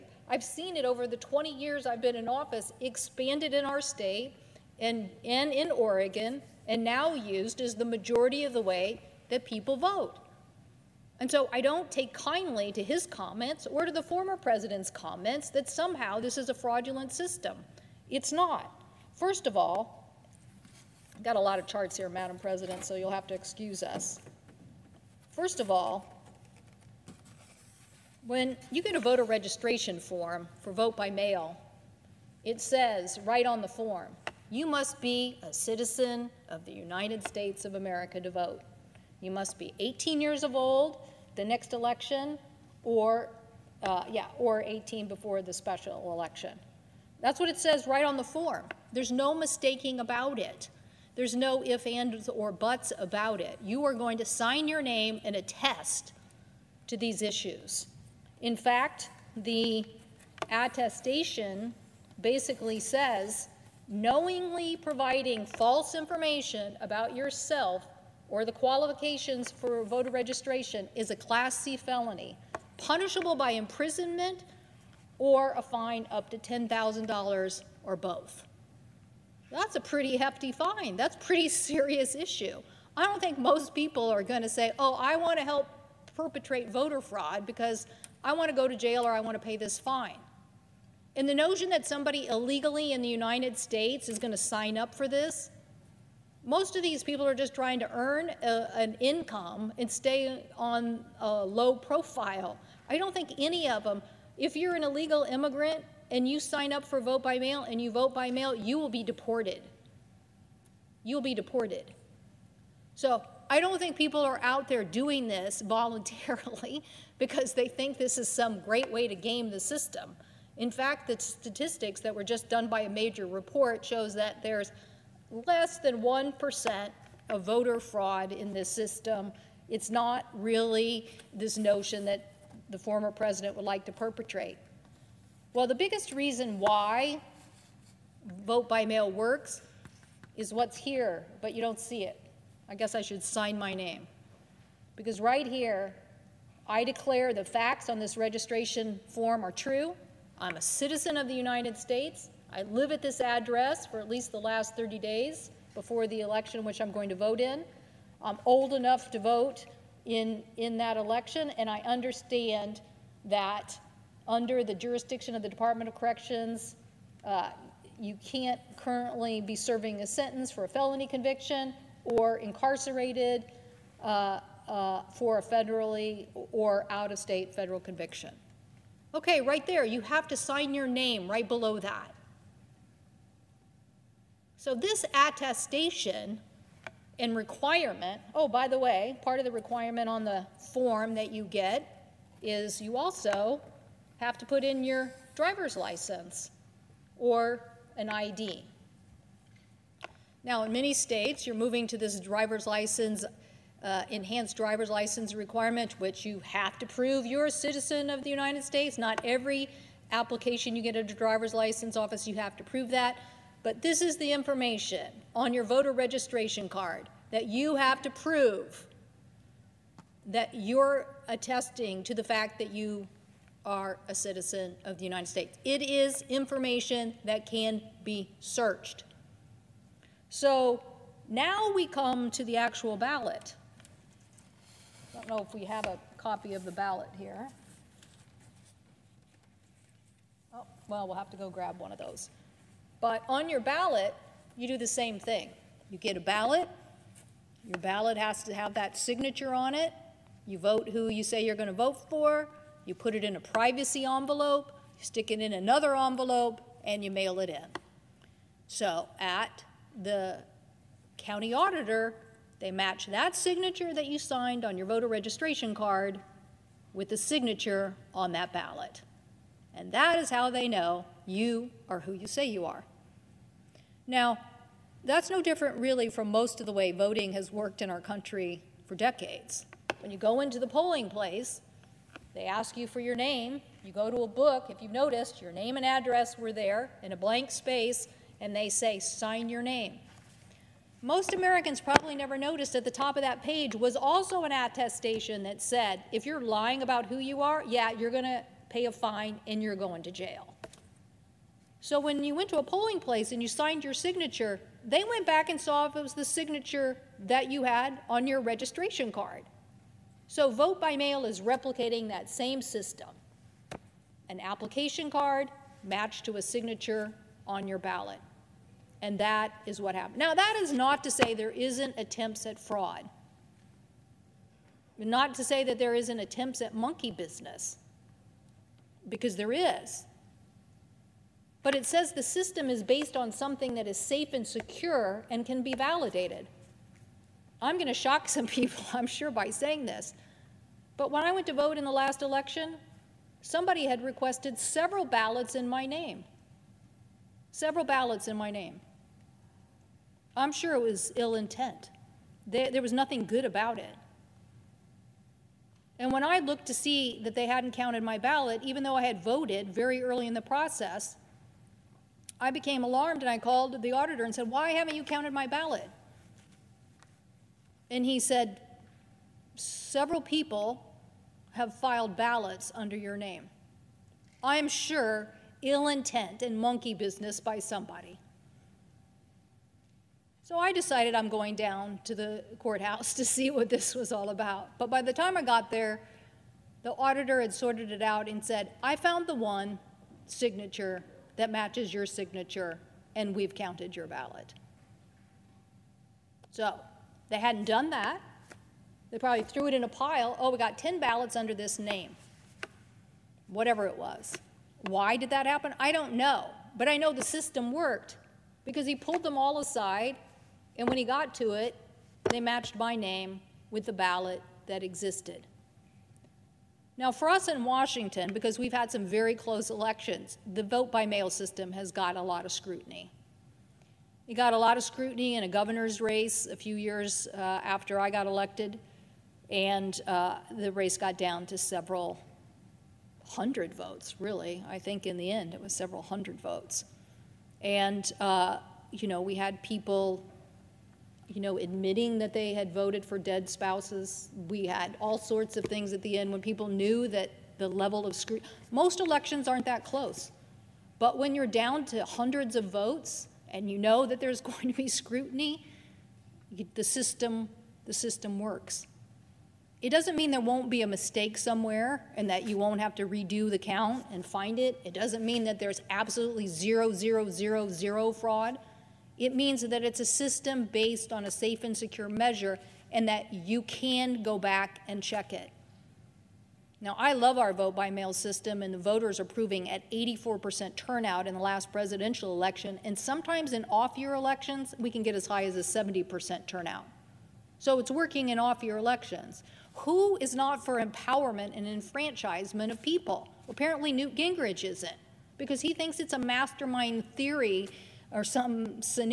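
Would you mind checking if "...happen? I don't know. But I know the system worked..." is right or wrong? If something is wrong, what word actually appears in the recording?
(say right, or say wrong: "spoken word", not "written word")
right.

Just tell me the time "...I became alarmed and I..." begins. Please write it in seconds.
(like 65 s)
362 s.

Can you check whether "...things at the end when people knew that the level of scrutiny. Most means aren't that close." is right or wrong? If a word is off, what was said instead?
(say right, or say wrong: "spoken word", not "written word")
wrong: "elections", not "means".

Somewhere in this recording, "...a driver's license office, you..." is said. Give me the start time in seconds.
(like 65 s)
211 s.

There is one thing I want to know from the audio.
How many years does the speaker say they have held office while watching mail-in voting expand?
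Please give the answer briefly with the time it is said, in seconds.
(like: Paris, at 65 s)
20, at 1 s.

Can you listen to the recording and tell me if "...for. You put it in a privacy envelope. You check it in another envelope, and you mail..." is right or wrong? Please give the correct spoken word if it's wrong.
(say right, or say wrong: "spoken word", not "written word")
wrong: "stick", not "check".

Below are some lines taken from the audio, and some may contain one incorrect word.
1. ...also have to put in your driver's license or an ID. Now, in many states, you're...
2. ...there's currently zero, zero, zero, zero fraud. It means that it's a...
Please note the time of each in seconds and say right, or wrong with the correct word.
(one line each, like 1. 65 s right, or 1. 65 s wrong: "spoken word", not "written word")
1. 192 s right
2. 465 s wrong: "absolutely", not "currently".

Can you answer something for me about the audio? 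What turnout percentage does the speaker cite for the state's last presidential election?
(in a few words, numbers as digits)
84%.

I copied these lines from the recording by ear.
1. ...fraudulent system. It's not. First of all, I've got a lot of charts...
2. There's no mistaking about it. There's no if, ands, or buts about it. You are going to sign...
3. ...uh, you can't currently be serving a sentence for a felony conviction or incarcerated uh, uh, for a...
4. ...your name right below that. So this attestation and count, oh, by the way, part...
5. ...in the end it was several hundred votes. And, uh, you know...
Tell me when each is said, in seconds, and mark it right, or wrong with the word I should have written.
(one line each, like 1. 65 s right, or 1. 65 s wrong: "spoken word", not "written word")
1. 16 s right
2. 48 s right
3. 167 s right
4. 180 s wrong: "requirement", not "count"
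5. 435 s right.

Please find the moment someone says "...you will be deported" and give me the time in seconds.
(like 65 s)
108 s.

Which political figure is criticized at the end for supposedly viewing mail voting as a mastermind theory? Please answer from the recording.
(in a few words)
Newt Gingrich.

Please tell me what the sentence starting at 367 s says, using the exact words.
And he said, Several people have filed ballots under your name.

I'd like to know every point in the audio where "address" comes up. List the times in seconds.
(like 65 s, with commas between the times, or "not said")
153 s, 285 s.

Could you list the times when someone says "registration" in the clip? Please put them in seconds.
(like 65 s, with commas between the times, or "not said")
29 s, 70 s, 148 s, 215 s, 265 s, 308 s.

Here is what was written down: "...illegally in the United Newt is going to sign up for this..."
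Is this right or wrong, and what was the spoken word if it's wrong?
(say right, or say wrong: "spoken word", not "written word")
wrong: "States", not "Newt".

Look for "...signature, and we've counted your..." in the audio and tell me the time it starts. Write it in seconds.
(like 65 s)
392 s.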